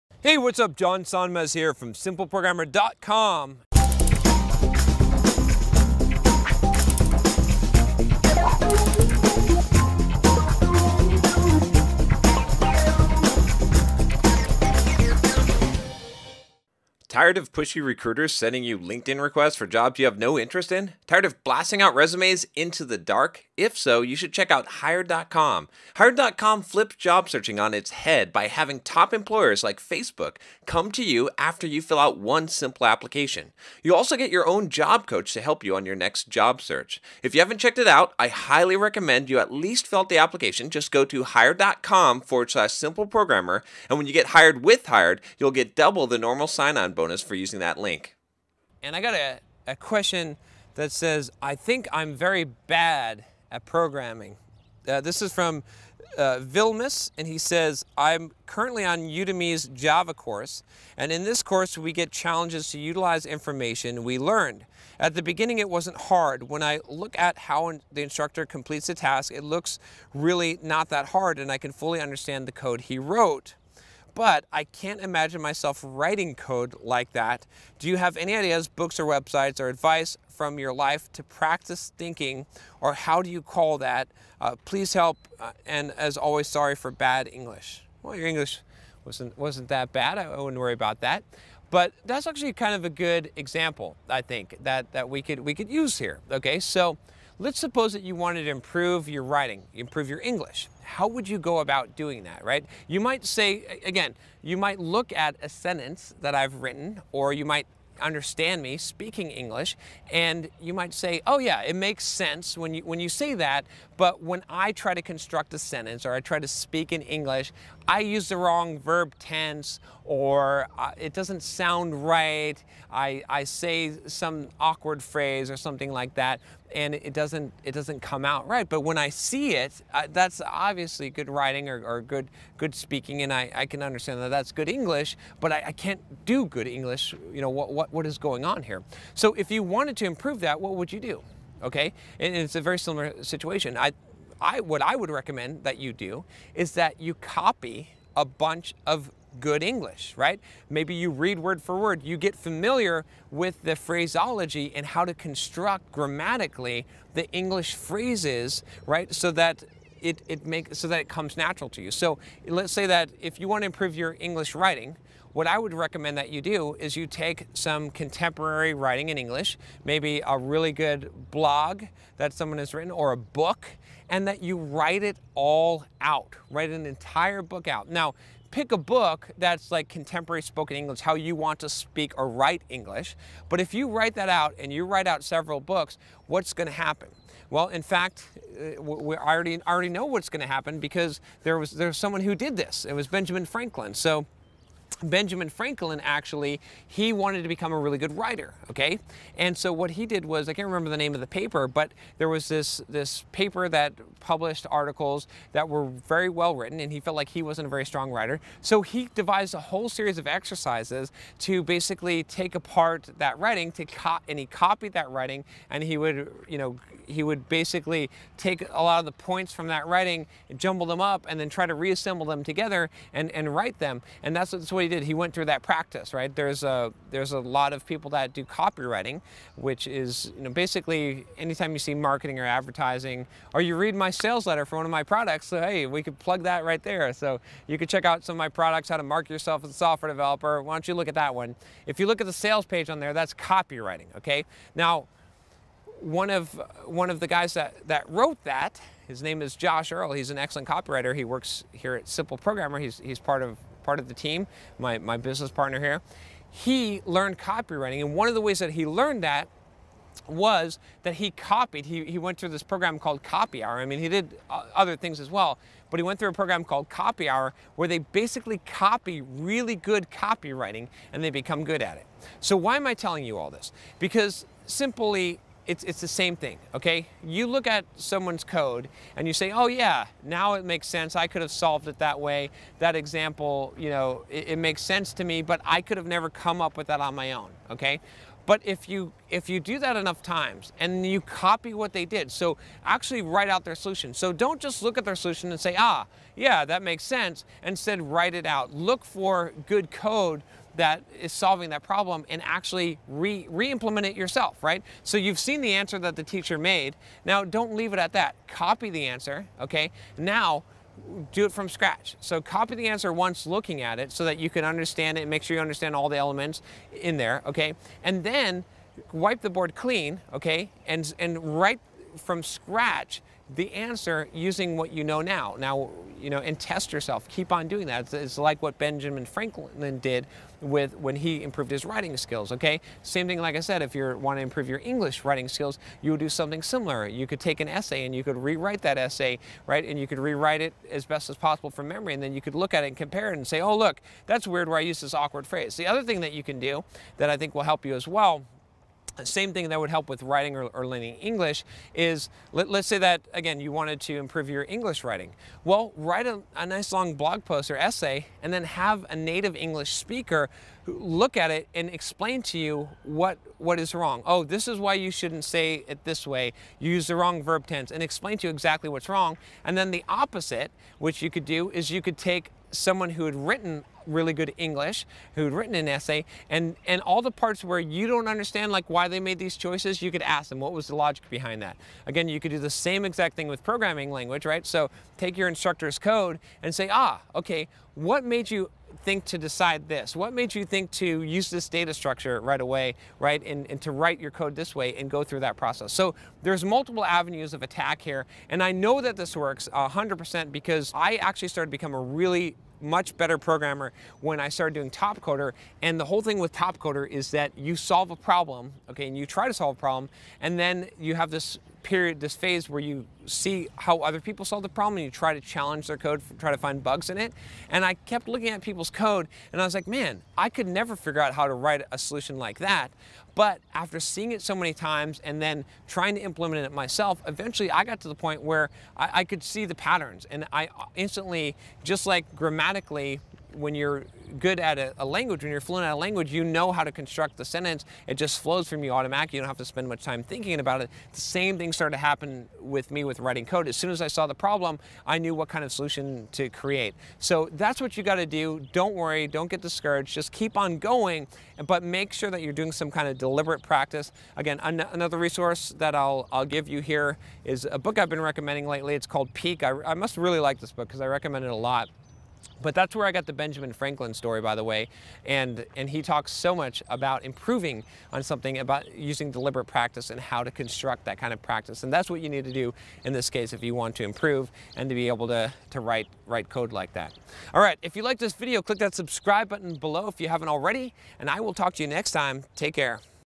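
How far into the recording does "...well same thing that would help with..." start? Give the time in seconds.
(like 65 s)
348 s.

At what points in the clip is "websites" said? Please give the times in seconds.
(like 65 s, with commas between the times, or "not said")
79 s.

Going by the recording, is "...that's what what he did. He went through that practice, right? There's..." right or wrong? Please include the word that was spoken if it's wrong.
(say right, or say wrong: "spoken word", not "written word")
right.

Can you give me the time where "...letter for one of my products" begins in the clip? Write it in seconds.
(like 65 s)
234 s.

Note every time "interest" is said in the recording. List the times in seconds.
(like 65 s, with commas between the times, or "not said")
20 s.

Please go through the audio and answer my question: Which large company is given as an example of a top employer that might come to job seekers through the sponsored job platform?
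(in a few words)
Facebook.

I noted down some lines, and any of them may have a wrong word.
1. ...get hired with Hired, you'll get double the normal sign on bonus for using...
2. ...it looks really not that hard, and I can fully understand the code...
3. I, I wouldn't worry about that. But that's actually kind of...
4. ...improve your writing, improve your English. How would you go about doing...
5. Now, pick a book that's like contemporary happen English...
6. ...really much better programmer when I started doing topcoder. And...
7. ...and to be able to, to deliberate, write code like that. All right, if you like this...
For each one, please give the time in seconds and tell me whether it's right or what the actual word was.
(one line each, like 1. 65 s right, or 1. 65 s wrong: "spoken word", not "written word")
1. 44 s right
2. 69 s right
3. 90 s right
4. 98 s right
5. 177 s wrong: "spoken", not "happen"
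6. 402 s right
7. 474 s wrong: "write", not "deliberate".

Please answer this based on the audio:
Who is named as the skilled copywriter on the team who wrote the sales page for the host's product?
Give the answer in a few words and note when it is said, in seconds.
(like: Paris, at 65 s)
Josh Earl, at 249 s.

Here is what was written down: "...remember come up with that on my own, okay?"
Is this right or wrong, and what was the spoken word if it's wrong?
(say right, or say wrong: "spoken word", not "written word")
wrong: "never", not "remember".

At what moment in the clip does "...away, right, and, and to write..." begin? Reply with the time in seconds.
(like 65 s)
392 s.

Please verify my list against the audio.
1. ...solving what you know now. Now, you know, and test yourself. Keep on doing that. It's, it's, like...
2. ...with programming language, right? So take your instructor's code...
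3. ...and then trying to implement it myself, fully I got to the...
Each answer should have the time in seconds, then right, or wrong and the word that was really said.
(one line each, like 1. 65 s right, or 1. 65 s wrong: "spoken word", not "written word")
1. 324 s wrong: "using", not "solving"
2. 383 s right
3. 425 s wrong: "eventually", not "fully".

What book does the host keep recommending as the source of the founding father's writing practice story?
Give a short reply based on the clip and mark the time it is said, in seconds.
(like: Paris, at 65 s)
Peak, at 459 s.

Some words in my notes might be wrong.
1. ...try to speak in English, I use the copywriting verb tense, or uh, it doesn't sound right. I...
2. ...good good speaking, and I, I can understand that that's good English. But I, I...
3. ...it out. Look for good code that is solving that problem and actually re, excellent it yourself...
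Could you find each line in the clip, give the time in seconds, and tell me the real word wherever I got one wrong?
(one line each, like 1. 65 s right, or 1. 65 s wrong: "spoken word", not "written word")
1. 116 s wrong: "wrong", not "copywriting"
2. 132 s right
3. 298 s wrong: "implement", not "excellent".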